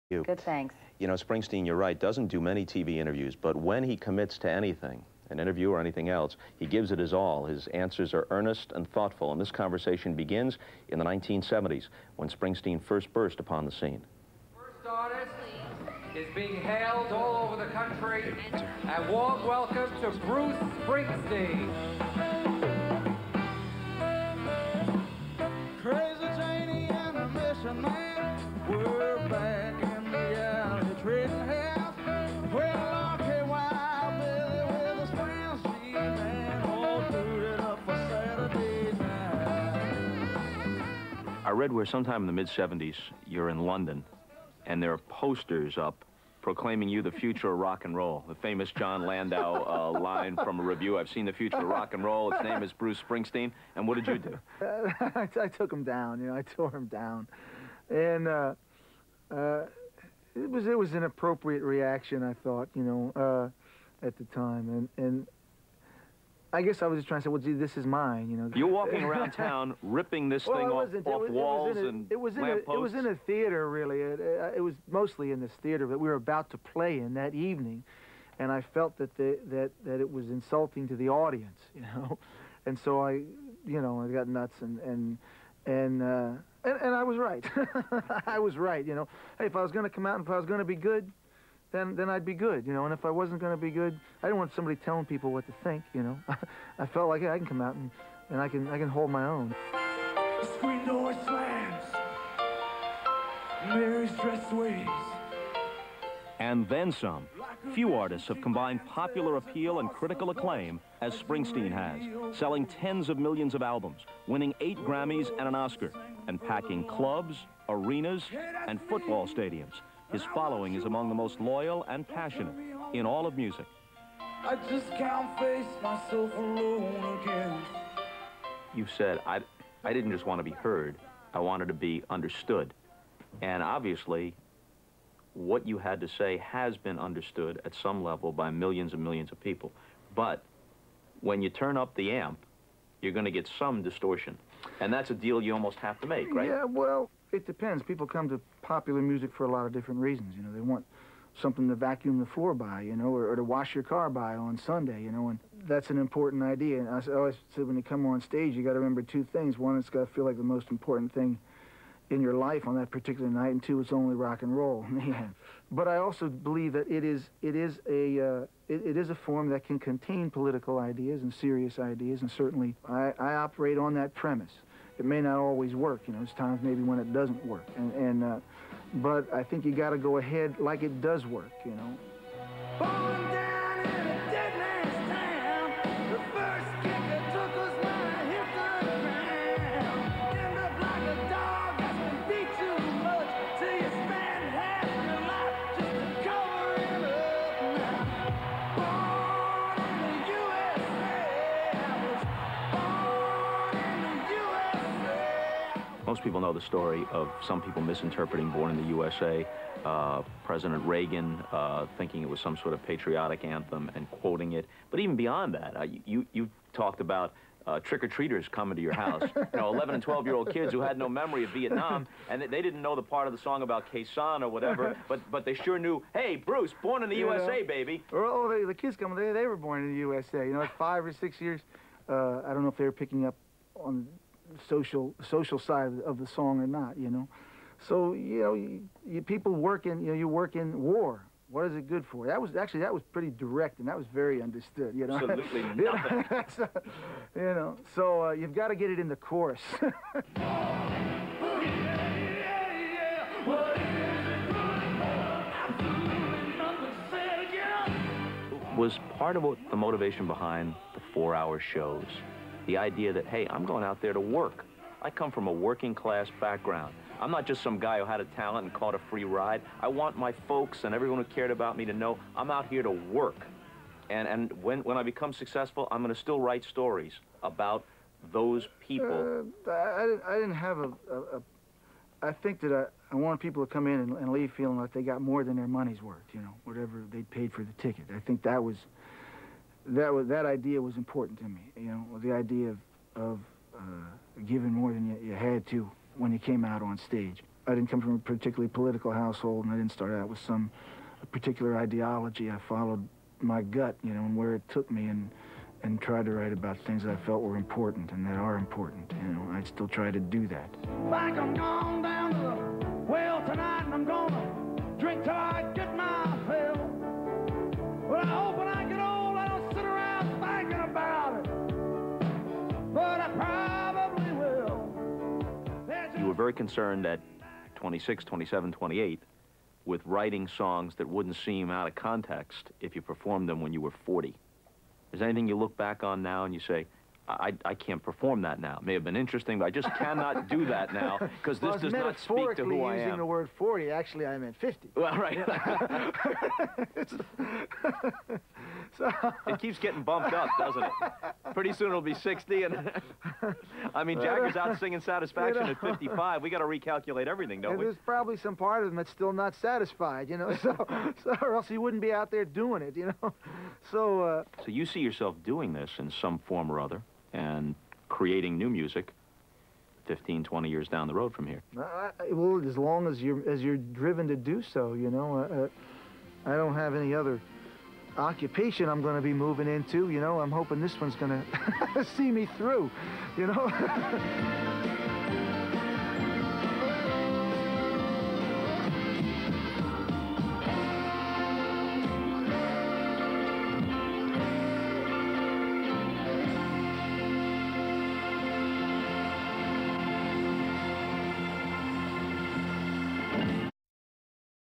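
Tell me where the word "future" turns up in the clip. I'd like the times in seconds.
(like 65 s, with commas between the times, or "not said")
47 s, 51 s.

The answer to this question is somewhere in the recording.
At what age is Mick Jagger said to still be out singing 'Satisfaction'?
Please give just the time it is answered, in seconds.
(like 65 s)
355 s.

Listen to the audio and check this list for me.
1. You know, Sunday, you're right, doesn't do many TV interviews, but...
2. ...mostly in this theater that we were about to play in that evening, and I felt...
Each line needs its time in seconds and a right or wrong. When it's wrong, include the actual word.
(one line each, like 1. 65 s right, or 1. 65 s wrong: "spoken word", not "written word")
1. 0 s wrong: "Springsteen", not "Sunday"
2. 74 s right.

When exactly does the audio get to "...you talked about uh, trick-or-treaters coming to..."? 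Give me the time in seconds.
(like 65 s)
216 s.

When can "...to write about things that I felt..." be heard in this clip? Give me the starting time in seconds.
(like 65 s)
306 s.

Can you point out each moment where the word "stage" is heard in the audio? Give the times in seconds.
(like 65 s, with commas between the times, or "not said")
158 s, 296 s.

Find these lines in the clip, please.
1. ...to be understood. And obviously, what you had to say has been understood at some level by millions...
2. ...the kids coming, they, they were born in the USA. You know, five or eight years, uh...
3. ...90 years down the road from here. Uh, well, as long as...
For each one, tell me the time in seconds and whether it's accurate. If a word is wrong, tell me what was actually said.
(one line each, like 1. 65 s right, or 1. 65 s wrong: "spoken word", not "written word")
1. 131 s right
2. 228 s wrong: "six", not "eight"
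3. 370 s wrong: "20", not "90".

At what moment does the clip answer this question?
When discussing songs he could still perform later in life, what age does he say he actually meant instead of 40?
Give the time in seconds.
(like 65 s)
344 s.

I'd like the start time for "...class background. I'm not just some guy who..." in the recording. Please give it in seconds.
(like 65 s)
265 s.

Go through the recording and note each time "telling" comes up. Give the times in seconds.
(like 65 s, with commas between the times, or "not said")
94 s.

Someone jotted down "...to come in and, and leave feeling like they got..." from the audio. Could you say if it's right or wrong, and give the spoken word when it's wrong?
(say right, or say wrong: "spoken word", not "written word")
right.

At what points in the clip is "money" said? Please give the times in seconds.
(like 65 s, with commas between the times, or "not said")
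285 s.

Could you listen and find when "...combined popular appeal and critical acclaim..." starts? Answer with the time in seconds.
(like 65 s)
108 s.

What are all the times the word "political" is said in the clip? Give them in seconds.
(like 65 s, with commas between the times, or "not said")
170 s, 298 s.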